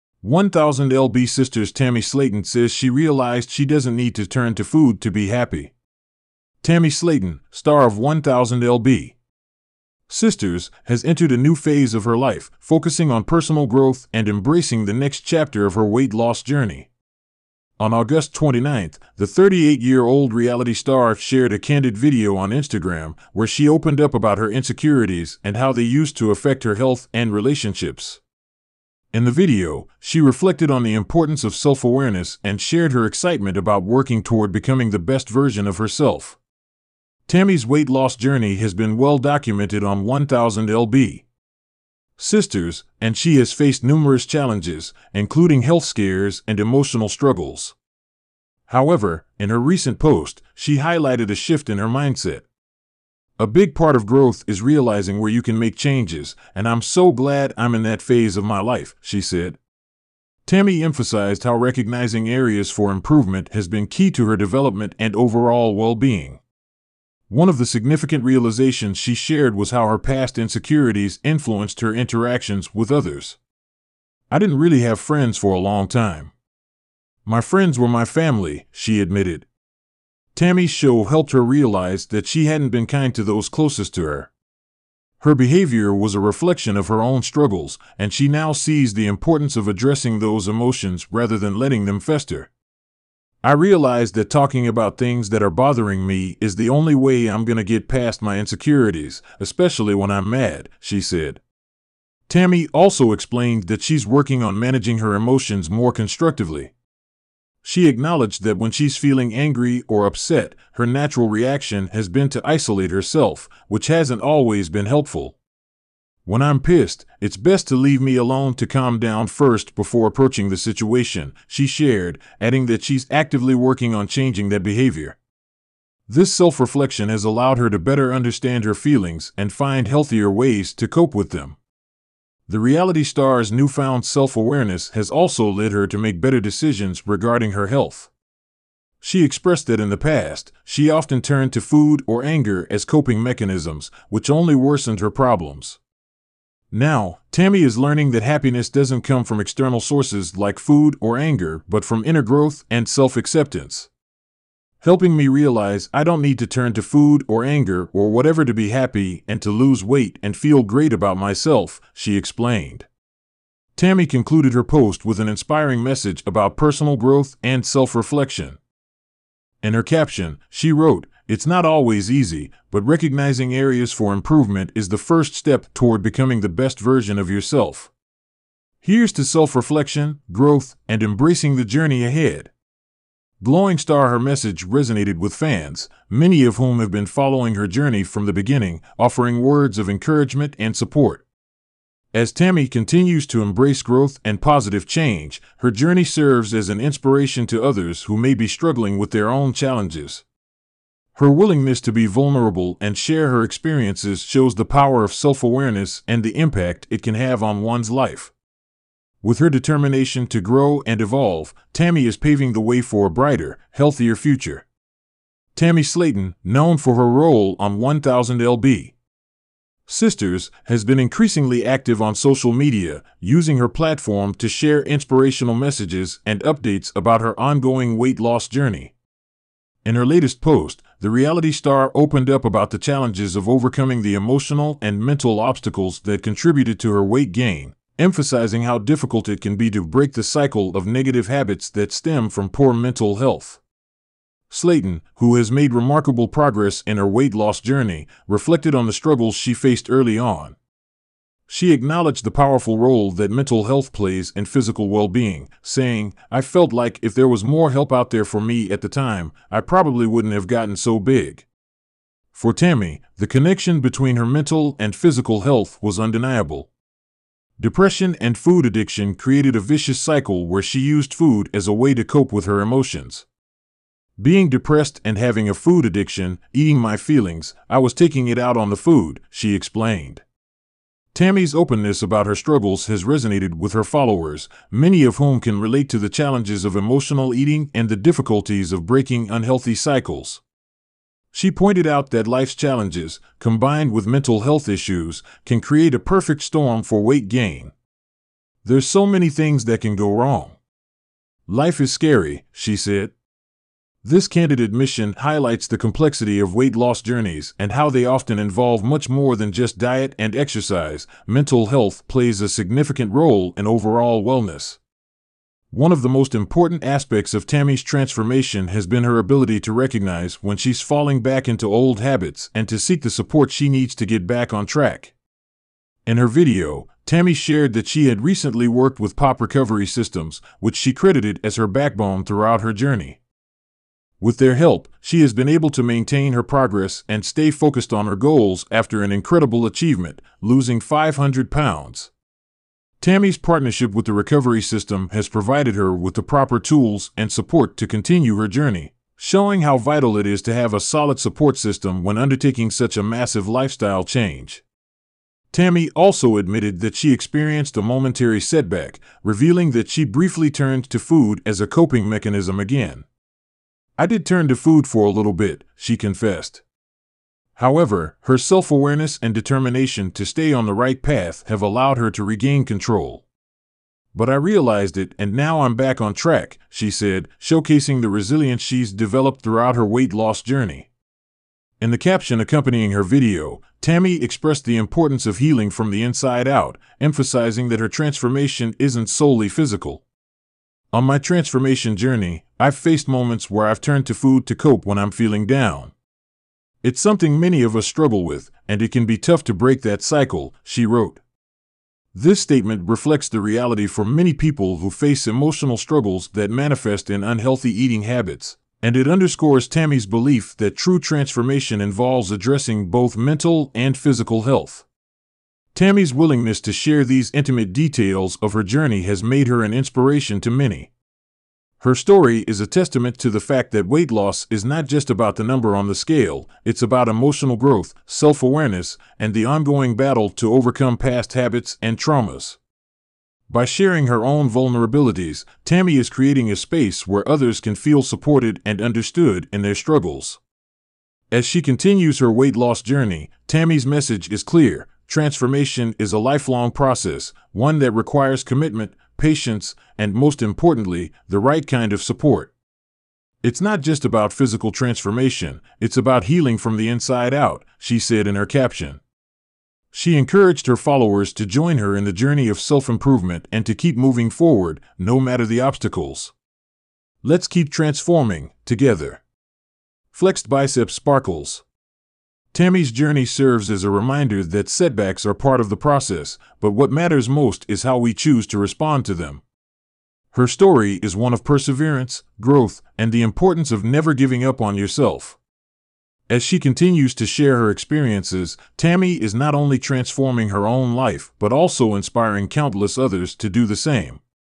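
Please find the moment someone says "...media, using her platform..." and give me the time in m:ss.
3:42.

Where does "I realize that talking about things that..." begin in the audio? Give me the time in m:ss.
1:33.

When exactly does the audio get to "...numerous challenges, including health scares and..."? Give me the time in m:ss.
0:43.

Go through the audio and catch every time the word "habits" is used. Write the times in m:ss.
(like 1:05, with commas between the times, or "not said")
4:01, 5:22, 6:48, 7:11.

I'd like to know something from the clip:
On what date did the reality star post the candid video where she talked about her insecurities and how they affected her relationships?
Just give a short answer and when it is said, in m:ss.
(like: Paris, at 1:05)
August 29th, at 0:17.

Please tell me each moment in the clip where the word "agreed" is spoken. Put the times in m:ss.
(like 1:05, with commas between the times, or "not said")
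not said.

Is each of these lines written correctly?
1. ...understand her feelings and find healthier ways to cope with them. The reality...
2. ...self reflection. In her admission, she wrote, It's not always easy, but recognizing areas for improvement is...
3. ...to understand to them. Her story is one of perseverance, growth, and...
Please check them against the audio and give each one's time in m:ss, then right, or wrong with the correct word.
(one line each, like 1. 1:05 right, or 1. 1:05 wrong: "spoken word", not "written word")
1. 2:08 right
2. 2:47 wrong: "caption", not "admission"
3. 7:58 wrong: "respond", not "understand".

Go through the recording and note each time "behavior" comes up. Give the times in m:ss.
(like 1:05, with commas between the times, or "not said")
1:25, 2:04.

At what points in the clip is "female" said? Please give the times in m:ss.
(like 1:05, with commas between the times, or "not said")
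not said.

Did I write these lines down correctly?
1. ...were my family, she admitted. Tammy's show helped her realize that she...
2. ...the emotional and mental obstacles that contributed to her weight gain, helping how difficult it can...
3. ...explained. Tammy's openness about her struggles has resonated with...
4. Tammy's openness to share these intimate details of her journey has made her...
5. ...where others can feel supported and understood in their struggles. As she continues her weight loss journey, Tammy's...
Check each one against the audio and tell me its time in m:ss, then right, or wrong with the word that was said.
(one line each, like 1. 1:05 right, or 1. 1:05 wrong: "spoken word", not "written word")
1. 1:17 right
2. 3:54 wrong: "emphasizing", not "helping"
3. 4:39 right
4. 6:55 wrong: "willingness", not "openness"
5. 7:17 right.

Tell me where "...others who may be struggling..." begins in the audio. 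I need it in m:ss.
3:17.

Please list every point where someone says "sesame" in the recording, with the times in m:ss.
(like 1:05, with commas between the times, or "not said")
not said.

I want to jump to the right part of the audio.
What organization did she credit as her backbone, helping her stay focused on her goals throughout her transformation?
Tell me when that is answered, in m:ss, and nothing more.
5:29.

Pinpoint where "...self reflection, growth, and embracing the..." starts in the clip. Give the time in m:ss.
2:59.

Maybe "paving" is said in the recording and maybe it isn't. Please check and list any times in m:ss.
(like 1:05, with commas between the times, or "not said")
3:32.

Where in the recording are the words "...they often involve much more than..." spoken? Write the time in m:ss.
5:07.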